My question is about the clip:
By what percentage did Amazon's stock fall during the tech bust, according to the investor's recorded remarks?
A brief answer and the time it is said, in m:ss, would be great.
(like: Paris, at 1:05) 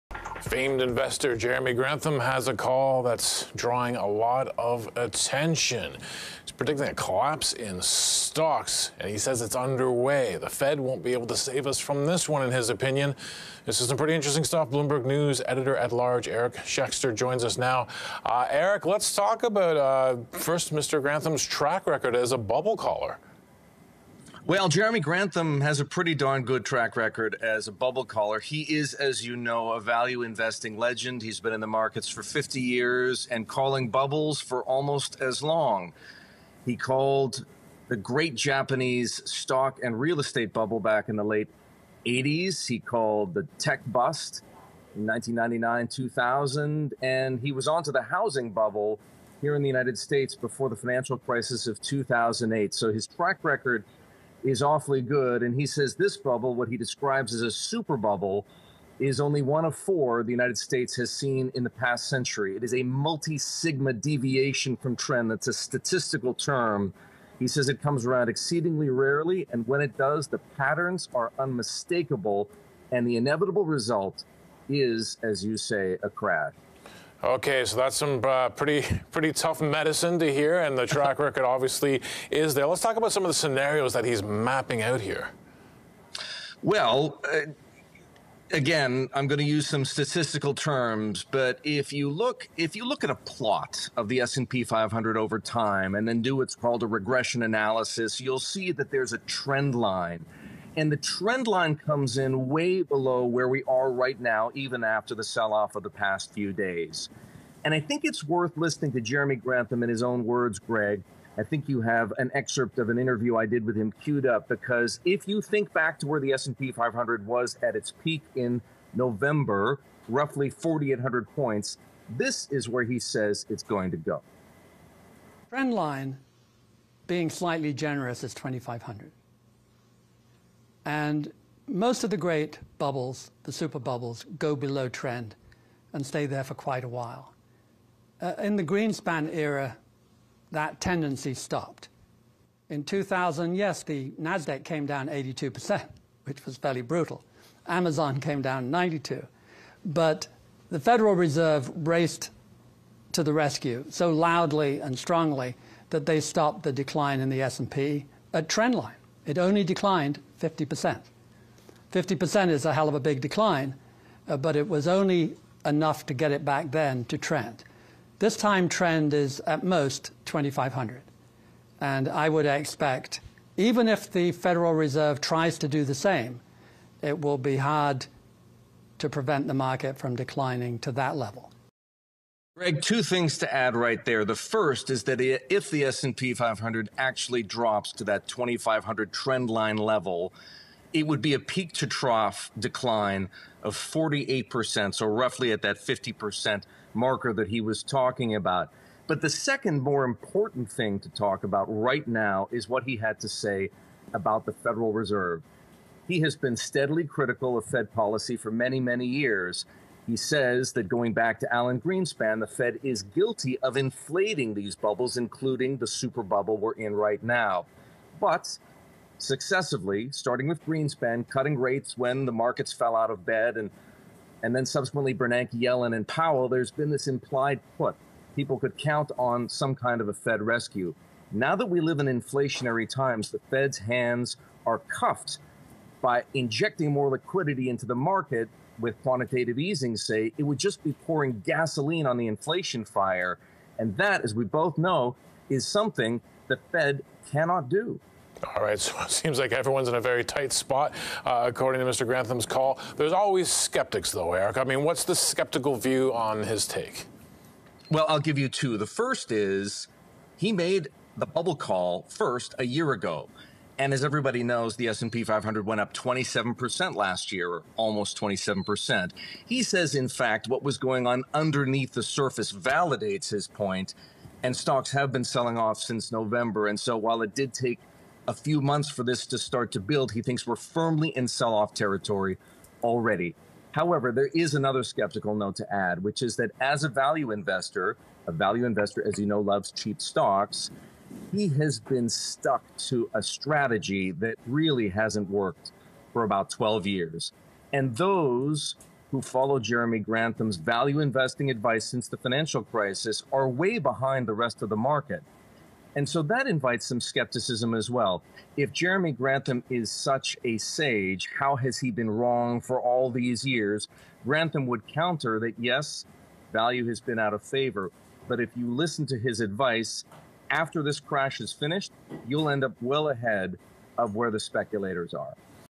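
92%, at 2:28.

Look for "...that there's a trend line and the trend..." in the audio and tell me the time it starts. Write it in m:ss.
1:38.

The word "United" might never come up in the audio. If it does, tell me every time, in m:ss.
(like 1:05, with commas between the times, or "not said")
0:49, 1:00.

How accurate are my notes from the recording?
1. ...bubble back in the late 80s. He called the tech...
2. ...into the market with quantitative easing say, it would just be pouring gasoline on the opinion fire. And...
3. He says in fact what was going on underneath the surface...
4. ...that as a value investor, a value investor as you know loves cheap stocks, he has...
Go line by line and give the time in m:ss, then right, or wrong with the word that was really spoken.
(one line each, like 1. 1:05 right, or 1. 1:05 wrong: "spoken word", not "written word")
1. 0:40 right
2. 3:57 wrong: "inflation", not "opinion"
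3. 4:29 right
4. 4:46 right.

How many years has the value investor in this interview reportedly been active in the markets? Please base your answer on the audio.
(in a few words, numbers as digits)
50.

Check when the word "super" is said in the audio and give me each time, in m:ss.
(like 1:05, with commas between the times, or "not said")
0:57, 2:13, 3:35.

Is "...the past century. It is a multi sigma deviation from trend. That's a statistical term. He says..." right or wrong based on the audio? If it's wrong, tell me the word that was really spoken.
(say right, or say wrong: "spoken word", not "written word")
right.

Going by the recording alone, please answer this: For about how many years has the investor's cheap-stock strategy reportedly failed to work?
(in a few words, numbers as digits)
12.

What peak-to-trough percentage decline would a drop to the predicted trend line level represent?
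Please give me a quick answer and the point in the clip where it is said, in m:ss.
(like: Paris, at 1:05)
48%, at 3:13.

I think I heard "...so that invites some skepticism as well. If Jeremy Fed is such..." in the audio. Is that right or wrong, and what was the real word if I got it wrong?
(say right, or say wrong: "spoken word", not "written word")
wrong: "Grantham", not "Fed".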